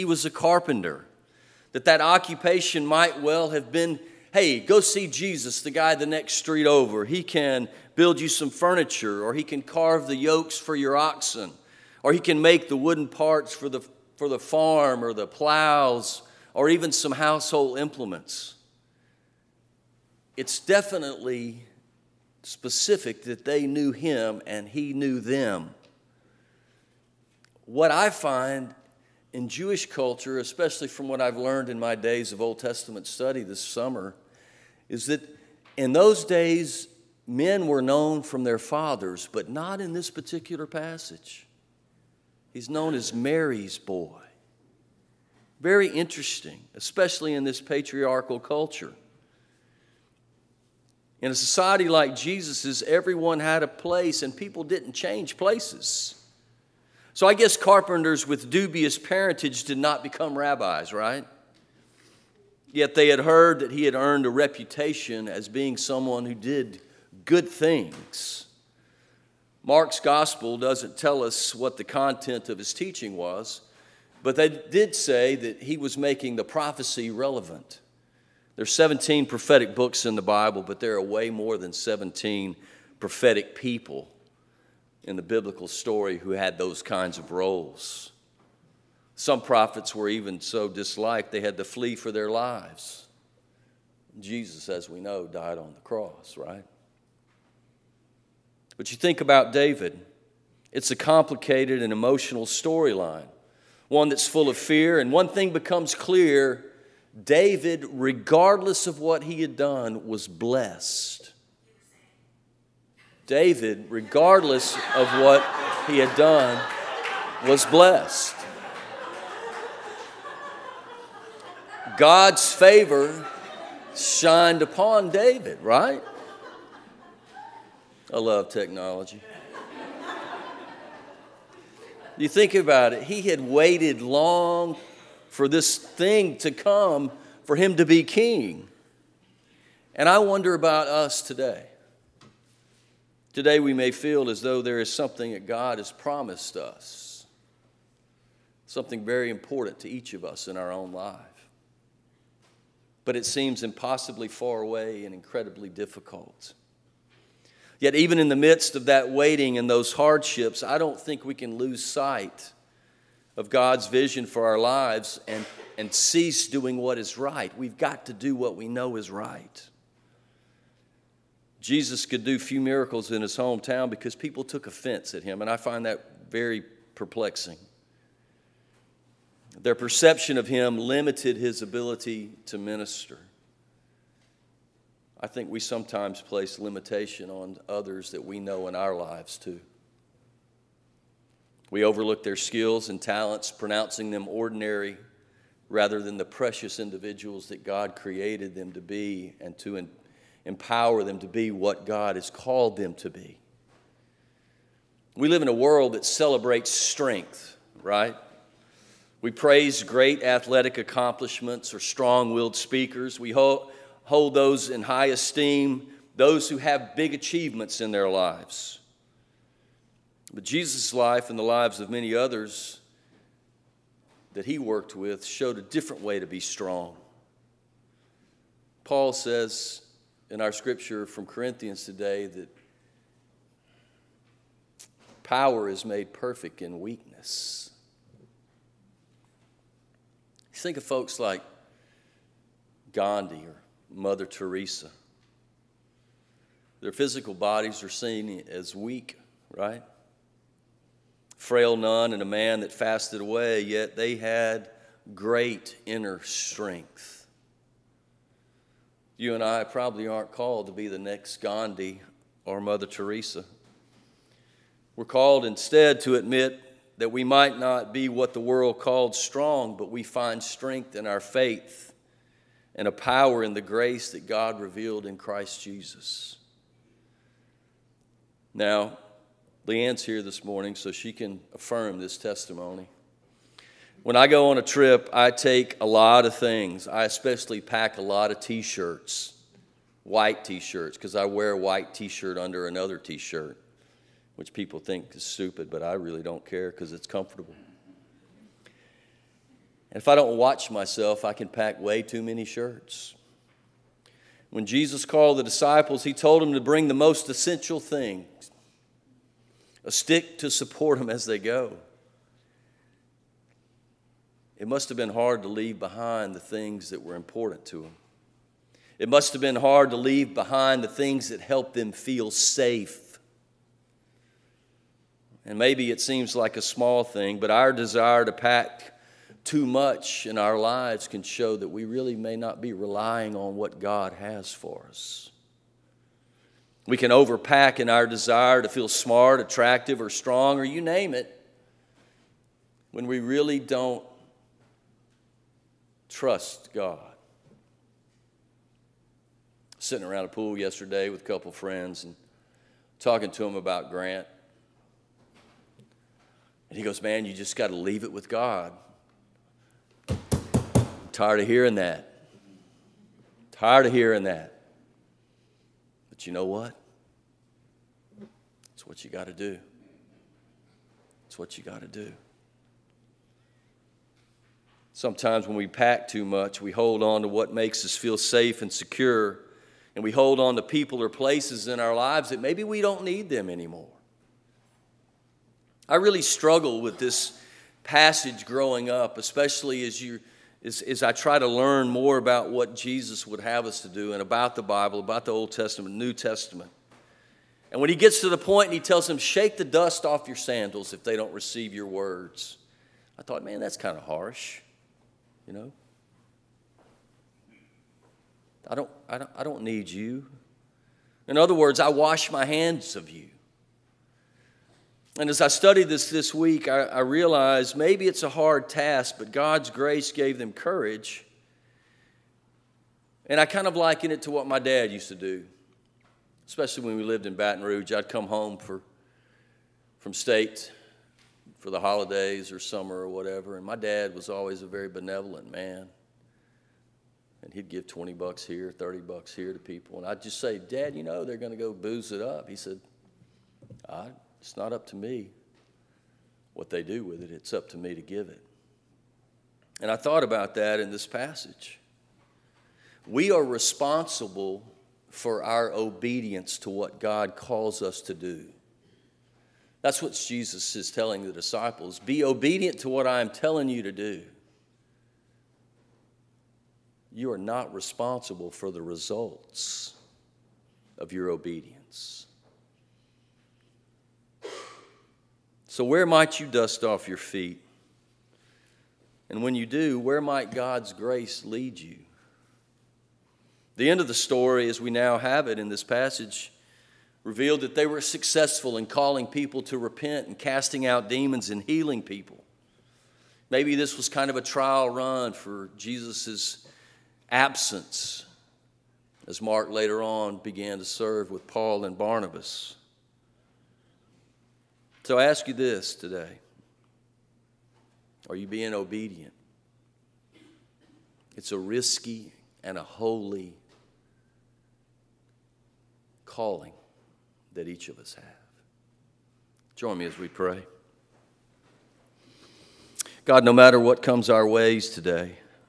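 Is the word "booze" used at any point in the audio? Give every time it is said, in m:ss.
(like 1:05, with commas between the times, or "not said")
7:21.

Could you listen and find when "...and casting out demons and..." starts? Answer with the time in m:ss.
8:10.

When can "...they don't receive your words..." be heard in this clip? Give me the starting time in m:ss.
6:41.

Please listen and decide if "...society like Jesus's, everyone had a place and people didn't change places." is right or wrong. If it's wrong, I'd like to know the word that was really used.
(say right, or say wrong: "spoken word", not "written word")
right.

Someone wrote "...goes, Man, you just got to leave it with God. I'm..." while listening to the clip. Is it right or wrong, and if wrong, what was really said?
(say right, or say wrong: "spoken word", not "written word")
right.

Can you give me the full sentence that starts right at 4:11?
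frail nun and a man that fasted away, yet they had great inner strength.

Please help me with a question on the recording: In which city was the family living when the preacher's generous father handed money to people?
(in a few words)
Baton Rouge.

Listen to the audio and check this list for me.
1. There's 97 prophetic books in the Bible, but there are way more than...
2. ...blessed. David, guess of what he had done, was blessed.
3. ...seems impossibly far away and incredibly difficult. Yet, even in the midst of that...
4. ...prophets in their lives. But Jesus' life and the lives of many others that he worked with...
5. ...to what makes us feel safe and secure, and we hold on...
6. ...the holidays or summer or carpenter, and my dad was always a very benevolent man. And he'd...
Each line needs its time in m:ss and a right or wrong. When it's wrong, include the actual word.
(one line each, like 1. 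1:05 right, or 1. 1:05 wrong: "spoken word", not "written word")
1. 1:18 wrong: "17", not "97"
2. 1:50 wrong: "regardless", not "guess"
3. 2:33 right
4. 3:37 wrong: "achievements", not "prophets"
5. 6:17 right
6. 7:11 wrong: "whatever", not "carpenter".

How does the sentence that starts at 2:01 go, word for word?
God's favor shined upon David, right?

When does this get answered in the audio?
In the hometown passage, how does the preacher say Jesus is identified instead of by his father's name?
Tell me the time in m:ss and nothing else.
0:43.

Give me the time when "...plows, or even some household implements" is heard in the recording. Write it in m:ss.
0:15.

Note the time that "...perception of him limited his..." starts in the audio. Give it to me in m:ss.
2:59.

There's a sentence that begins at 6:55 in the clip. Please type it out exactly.
And as I studied this this week, I, I, realized maybe it's a hard task, but God's grace gave them courage.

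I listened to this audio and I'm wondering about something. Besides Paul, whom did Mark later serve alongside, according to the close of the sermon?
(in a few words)
Barnabas.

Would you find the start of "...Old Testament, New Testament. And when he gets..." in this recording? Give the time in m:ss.
6:35.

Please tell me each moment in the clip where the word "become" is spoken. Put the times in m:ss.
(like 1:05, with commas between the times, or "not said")
1:00, 1:45.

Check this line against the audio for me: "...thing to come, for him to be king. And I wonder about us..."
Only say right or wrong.
right.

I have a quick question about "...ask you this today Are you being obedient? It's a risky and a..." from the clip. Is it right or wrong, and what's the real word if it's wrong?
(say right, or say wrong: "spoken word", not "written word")
right.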